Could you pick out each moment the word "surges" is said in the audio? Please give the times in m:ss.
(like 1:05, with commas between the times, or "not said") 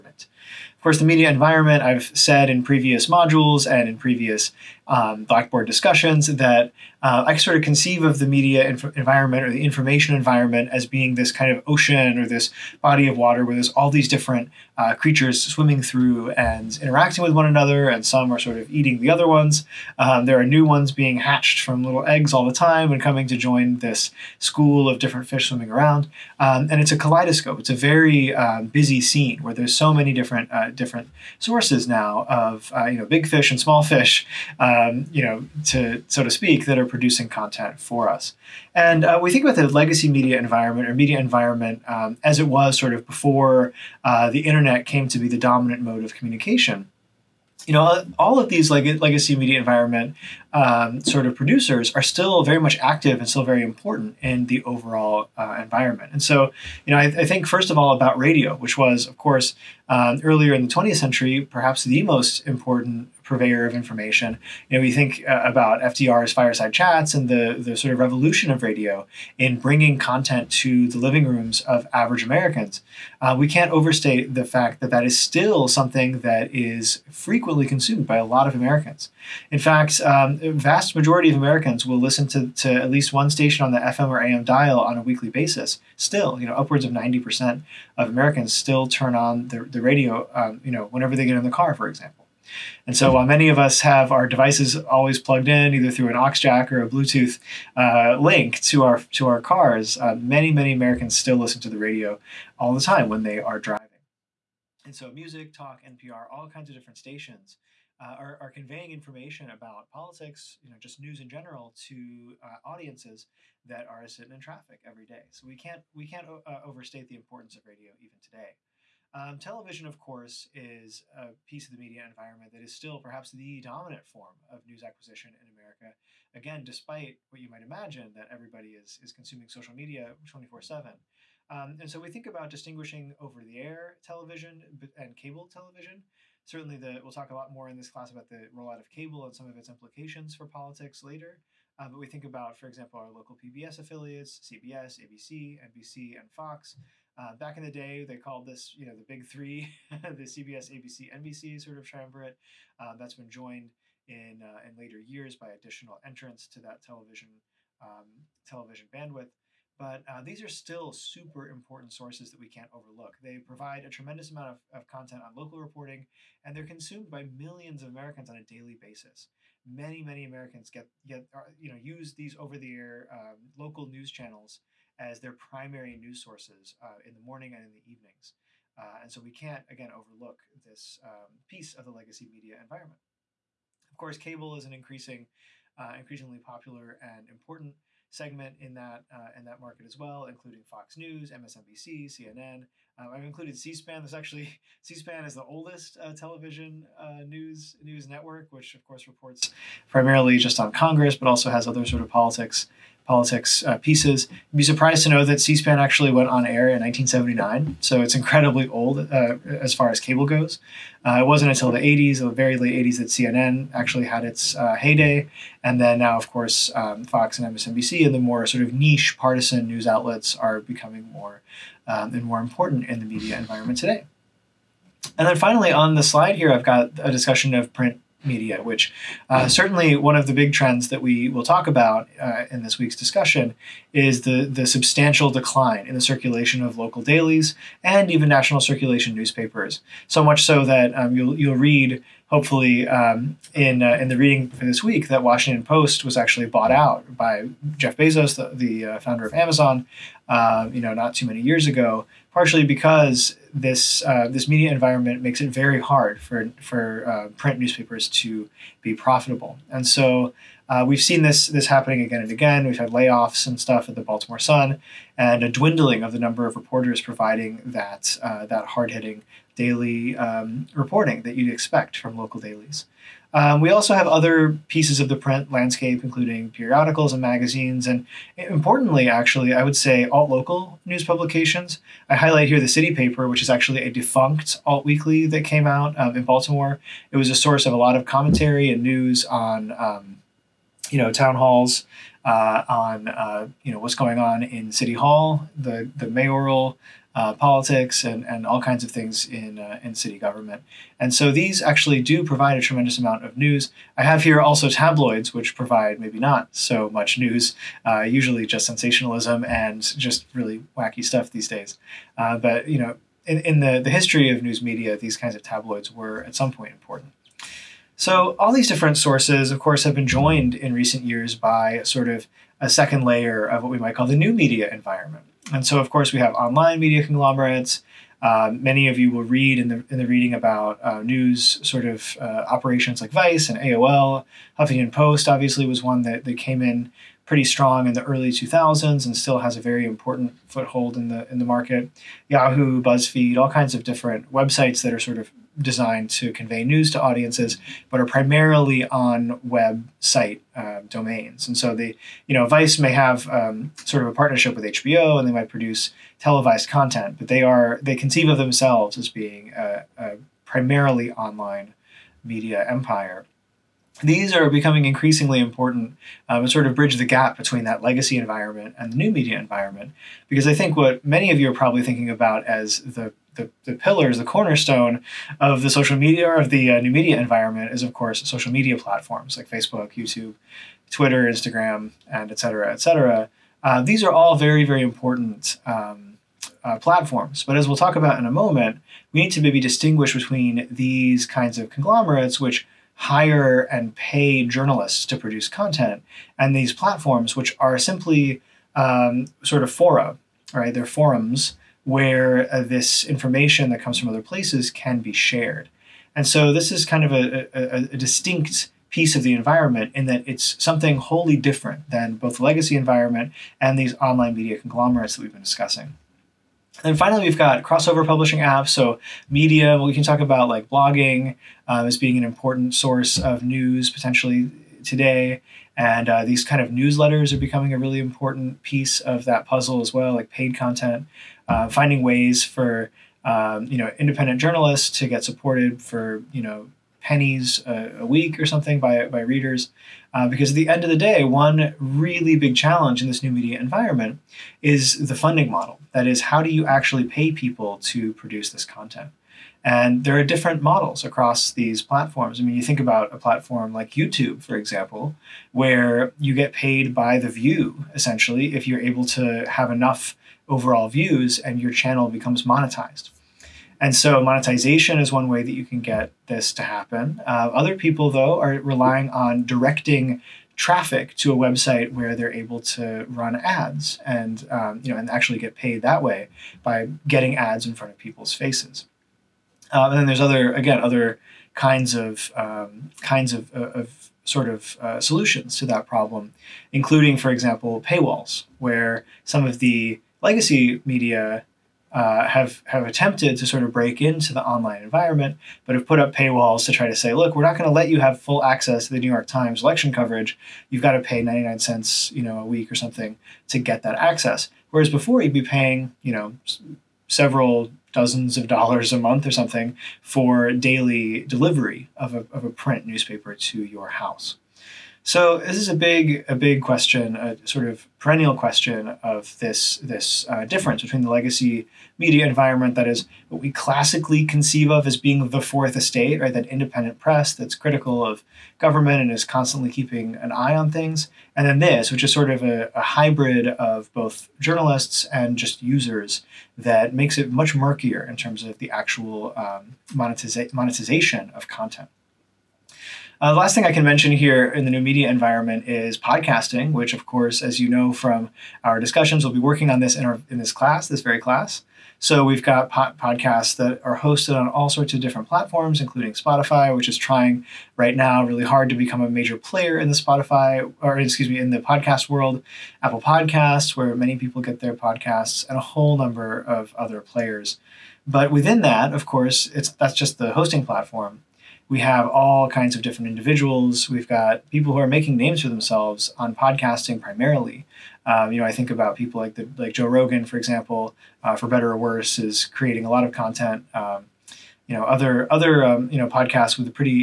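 not said.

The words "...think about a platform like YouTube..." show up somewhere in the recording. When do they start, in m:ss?
7:32.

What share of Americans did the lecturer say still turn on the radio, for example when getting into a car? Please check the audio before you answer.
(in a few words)
upwards of 90%.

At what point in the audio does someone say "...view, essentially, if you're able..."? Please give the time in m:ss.
7:37.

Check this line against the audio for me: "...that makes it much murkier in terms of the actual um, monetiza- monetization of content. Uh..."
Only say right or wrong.
right.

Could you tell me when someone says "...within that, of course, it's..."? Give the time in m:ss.
9:28.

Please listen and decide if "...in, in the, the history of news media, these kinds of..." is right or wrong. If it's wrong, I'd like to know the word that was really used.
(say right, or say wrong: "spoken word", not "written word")
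right.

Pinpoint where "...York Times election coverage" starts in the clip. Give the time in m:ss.
8:19.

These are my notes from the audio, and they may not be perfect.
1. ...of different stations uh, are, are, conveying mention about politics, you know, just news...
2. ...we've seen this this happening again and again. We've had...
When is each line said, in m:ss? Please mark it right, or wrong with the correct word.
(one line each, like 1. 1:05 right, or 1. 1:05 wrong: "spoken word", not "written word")
1. 1:46 wrong: "information", not "mention"
2. 4:20 right.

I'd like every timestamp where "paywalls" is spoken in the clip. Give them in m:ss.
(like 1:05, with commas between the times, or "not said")
8:07, 8:16.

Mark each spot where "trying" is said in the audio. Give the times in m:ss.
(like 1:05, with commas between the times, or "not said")
9:16.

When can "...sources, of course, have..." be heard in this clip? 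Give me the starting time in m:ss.
5:18.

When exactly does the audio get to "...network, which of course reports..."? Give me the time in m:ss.
3:18.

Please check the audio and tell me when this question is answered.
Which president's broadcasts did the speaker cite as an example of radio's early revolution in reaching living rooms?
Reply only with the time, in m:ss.
1:05.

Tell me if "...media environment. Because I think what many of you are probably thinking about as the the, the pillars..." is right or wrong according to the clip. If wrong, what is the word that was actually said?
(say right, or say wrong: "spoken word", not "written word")
right.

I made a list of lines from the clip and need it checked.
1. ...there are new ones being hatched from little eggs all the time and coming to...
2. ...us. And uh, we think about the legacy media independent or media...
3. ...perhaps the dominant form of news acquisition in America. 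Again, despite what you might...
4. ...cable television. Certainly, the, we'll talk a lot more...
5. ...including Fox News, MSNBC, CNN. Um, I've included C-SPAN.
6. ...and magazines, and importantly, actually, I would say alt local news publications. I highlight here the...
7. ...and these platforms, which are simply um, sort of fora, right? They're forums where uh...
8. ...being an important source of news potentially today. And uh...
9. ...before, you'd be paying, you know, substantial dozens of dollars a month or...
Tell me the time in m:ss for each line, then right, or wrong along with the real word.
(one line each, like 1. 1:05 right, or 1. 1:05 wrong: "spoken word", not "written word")
1. 0:20 right
2. 0:38 wrong: "environment", not "independent"
3. 2:02 right
4. 2:15 right
5. 3:10 right
6. 4:37 right
7. 6:36 right
8. 7:01 right
9. 8:24 wrong: "several", not "substantial".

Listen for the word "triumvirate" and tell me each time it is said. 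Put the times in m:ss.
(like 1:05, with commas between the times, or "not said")
2:31.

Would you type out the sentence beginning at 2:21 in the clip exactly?
Uh, but we think about, for example, our local PBS affiliates, CBS, ABC, NBC, and Fox.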